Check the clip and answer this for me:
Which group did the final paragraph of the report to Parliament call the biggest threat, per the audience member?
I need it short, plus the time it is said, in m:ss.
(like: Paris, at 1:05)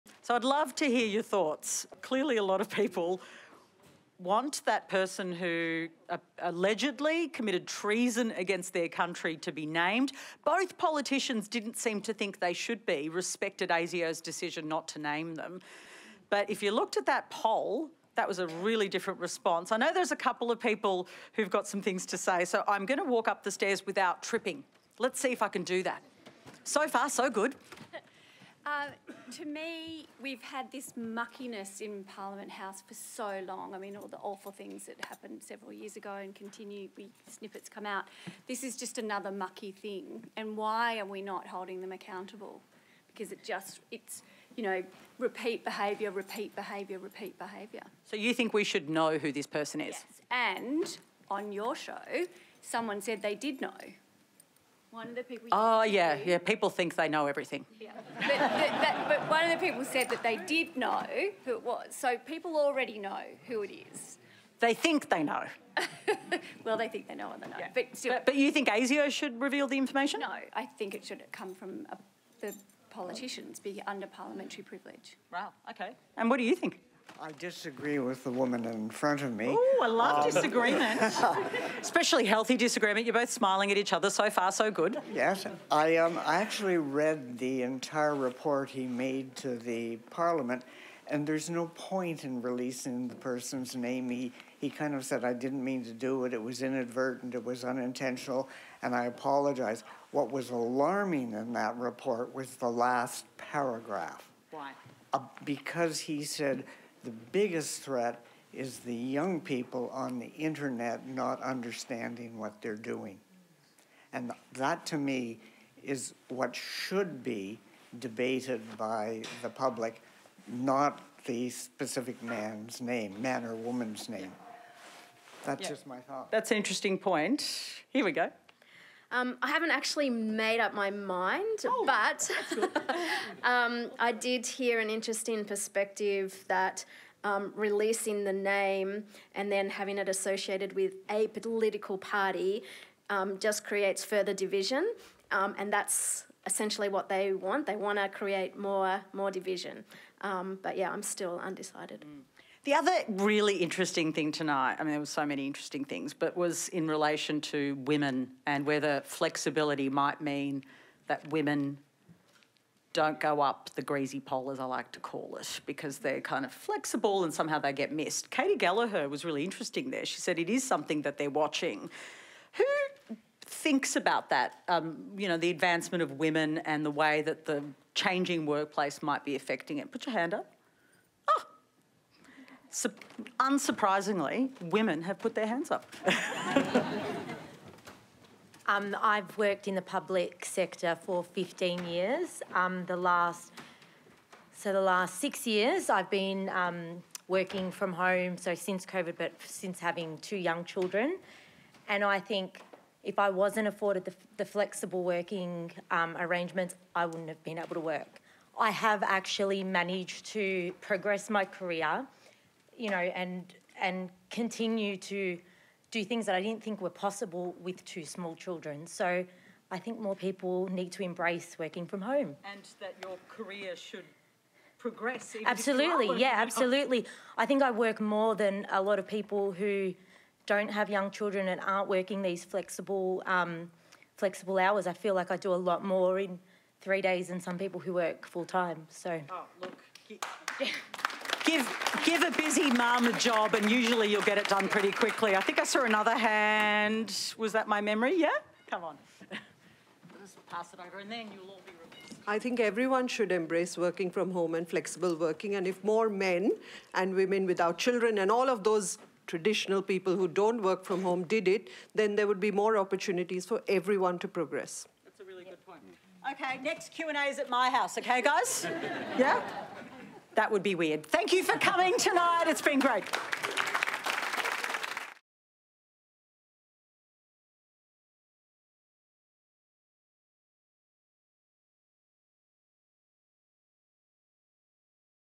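young people on the internet, at 1:48.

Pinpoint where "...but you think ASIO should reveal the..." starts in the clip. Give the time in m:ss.
1:08.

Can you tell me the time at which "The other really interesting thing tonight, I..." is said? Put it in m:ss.
2:32.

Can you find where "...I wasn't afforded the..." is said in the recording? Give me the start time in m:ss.
3:23.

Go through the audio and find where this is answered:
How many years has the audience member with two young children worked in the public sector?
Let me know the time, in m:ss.
3:11.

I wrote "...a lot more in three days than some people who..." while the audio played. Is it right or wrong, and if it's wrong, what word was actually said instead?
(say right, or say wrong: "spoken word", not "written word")
right.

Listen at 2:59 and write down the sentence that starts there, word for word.
Put your hand up unsurprisingly, women have put their hands up.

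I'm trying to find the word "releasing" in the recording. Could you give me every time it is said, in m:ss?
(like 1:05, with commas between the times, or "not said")
1:32, 2:17.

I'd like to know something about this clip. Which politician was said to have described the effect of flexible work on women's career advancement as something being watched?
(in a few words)
Katy Gallagher.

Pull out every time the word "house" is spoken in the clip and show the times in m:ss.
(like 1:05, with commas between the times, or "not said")
0:32, 4:27.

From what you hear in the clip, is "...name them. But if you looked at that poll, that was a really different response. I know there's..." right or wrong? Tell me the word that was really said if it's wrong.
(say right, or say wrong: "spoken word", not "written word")
right.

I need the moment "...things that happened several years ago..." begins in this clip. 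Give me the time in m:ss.
0:34.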